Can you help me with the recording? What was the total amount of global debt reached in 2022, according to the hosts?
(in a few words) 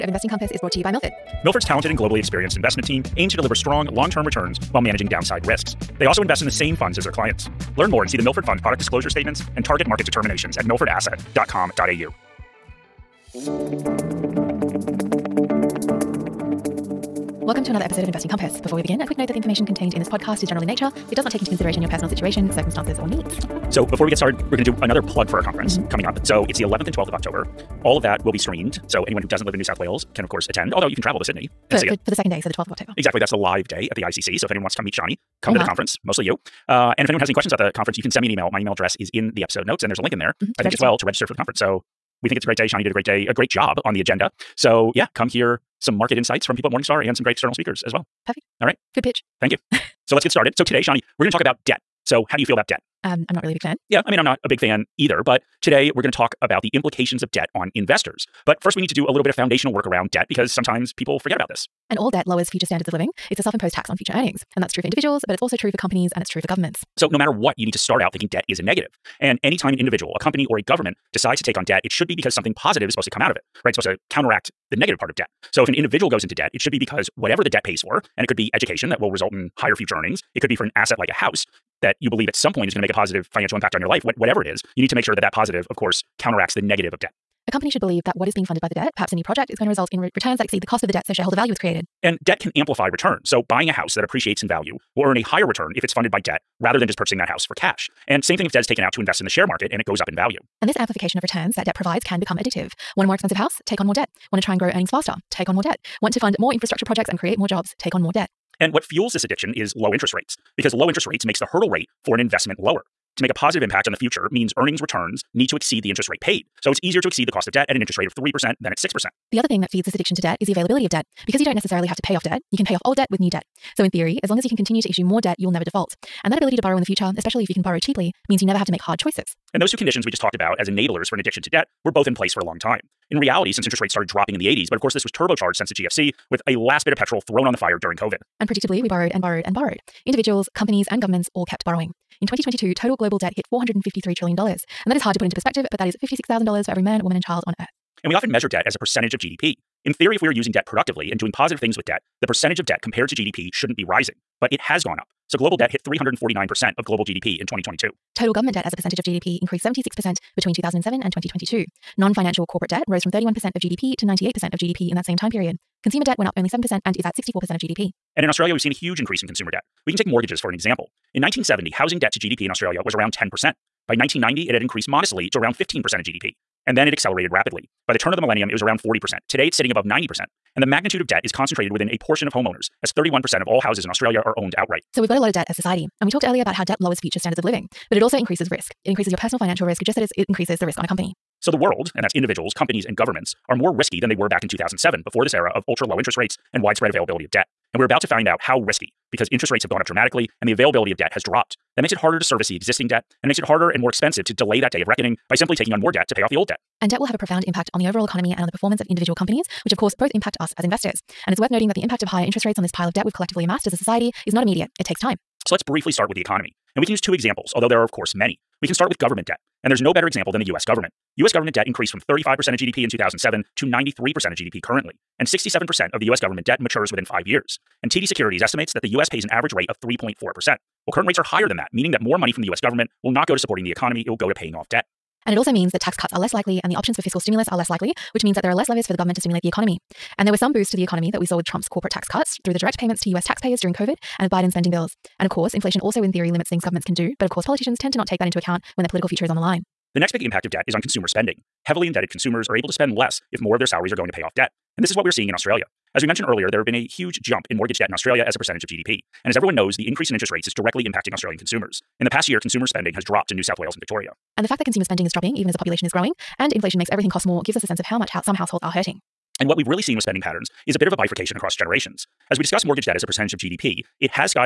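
$453 trillion.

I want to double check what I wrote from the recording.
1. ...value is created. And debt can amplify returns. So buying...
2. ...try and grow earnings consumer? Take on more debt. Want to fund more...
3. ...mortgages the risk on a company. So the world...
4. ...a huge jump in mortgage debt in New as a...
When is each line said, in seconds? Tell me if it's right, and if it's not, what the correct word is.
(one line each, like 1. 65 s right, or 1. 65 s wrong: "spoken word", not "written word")
1. 91 s right
2. 104 s wrong: "faster", not "consumer"
3. 190 s wrong: "increases", not "mortgages"
4. 256 s wrong: "Australia", not "New".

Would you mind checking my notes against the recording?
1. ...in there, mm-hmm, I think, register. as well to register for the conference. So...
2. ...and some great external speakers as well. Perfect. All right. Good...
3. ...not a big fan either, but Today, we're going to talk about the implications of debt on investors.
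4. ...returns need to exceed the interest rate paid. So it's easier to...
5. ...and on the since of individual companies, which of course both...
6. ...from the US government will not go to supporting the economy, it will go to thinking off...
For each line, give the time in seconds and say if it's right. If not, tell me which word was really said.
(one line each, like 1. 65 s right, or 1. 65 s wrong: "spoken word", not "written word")
1. 40 s right
2. 47 s right
3. 54 s right
4. 114 s right
5. 208 s wrong: "performance", not "since"
6. 232 s wrong: "paying", not "thinking".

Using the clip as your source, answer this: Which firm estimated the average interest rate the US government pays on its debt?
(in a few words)
TD Securities.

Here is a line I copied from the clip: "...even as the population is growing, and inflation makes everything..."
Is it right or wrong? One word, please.
right.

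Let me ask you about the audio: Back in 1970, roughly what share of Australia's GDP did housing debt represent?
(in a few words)
10%.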